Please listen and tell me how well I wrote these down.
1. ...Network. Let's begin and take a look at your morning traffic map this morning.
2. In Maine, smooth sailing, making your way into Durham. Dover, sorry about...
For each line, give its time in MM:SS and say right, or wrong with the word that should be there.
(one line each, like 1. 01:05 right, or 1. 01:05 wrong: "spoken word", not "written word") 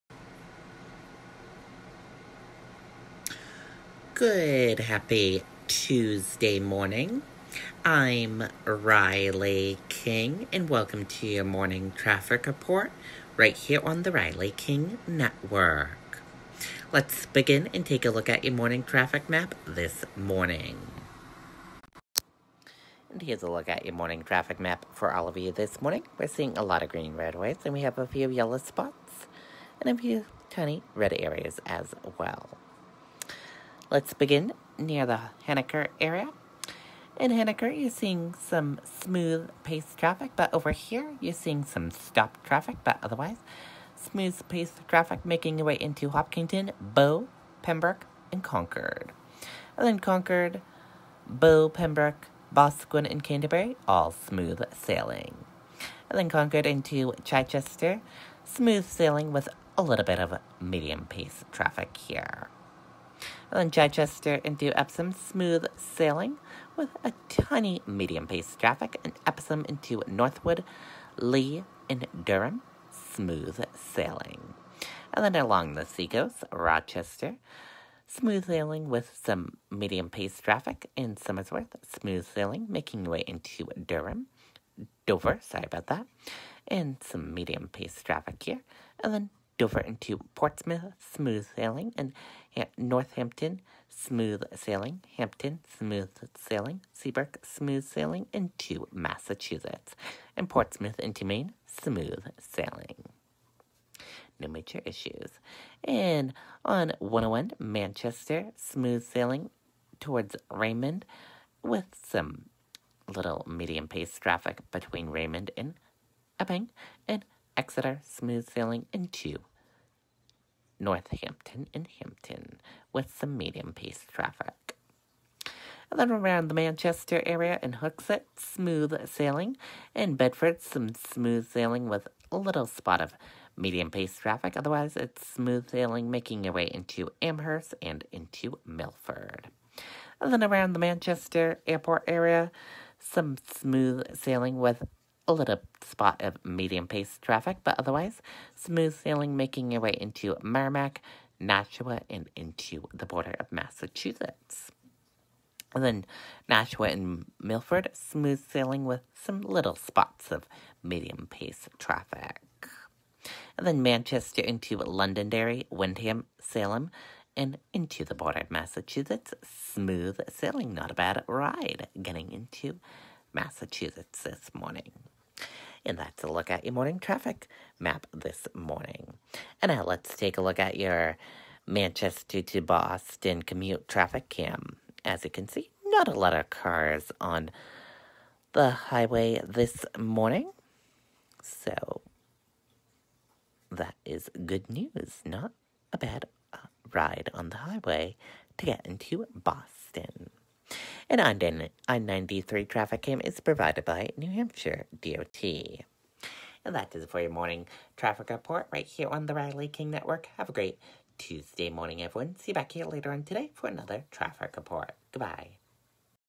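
1. 00:15 right
2. 01:20 wrong: "Somersworth", not "Maine".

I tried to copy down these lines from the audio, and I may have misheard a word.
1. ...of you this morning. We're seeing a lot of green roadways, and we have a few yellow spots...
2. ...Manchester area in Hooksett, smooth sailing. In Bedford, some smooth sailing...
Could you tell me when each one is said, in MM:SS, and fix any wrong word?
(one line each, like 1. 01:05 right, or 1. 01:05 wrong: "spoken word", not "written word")
1. 00:25 right
2. 02:06 right.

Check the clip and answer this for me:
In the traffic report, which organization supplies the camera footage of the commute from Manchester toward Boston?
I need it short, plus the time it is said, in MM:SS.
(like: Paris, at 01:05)
New Hampshire DOT, at 03:24.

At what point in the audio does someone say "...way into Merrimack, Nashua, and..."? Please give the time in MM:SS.
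02:29.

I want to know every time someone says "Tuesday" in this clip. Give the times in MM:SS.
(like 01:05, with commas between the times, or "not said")
00:05, 03:31.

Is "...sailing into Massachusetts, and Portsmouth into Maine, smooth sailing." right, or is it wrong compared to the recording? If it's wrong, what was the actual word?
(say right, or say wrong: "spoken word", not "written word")
right.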